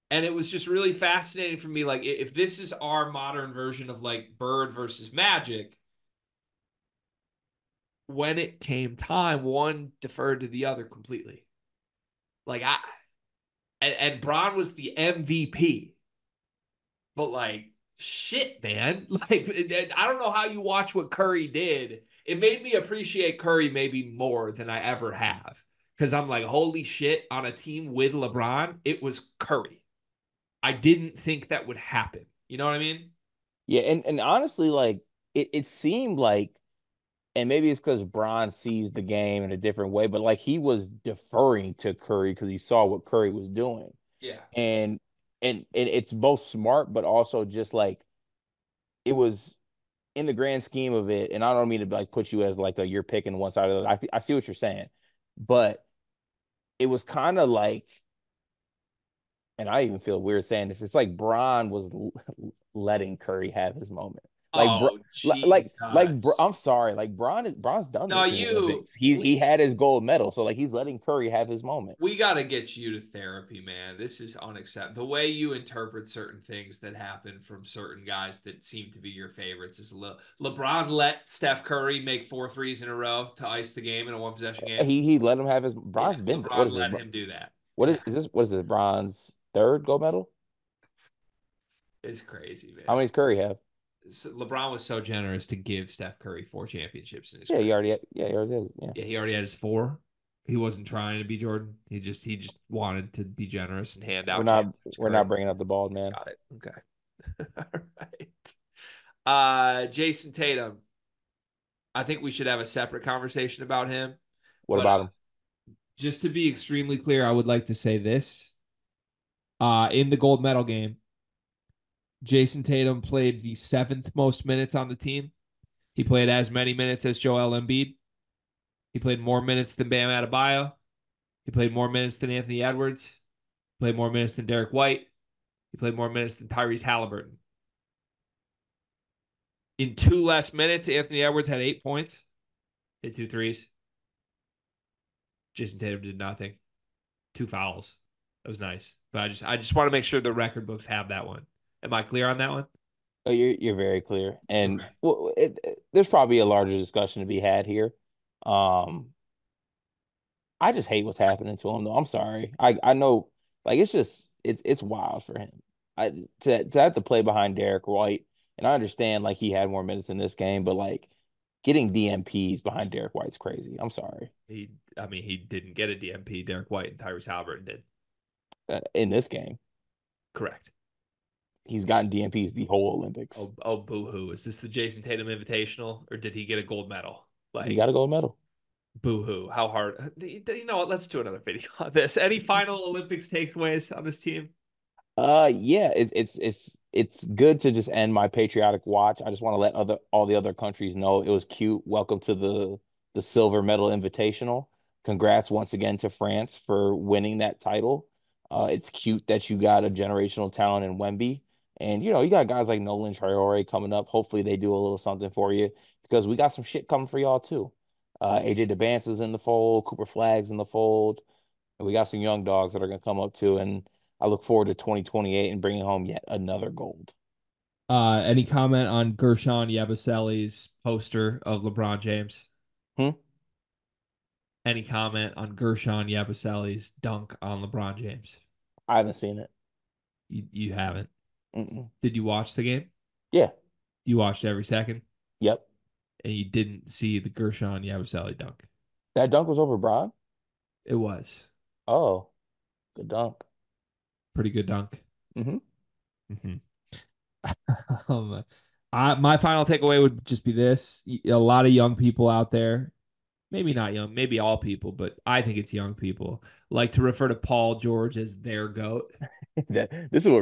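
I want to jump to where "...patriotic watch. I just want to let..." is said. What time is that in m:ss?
3:18.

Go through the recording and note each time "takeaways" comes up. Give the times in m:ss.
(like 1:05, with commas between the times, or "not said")
3:13, 4:19.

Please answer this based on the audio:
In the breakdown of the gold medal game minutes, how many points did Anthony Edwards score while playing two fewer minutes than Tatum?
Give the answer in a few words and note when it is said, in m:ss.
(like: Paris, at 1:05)
8, at 2:21.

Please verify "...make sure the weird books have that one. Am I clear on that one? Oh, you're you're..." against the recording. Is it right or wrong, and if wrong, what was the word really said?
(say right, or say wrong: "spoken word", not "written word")
wrong: "record", not "weird".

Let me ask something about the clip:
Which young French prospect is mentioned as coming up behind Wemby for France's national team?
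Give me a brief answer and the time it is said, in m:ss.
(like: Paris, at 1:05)
Nolan Traore, at 3:32.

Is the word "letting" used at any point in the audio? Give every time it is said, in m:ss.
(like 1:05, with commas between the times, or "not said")
1:02, 1:10.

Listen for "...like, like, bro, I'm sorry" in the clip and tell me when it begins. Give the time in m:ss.
1:05.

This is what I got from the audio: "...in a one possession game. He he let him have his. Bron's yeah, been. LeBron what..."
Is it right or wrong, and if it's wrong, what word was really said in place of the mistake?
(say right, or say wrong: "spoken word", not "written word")
right.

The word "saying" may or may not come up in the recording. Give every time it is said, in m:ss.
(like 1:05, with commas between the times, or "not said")
0:54, 1:00.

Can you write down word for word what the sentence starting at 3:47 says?
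Uh, any comment on Guerschon Yabusele's poster of LeBron James?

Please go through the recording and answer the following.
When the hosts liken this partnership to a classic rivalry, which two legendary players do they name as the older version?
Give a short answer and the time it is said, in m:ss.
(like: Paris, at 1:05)
Bird versus Magic, at 0:04.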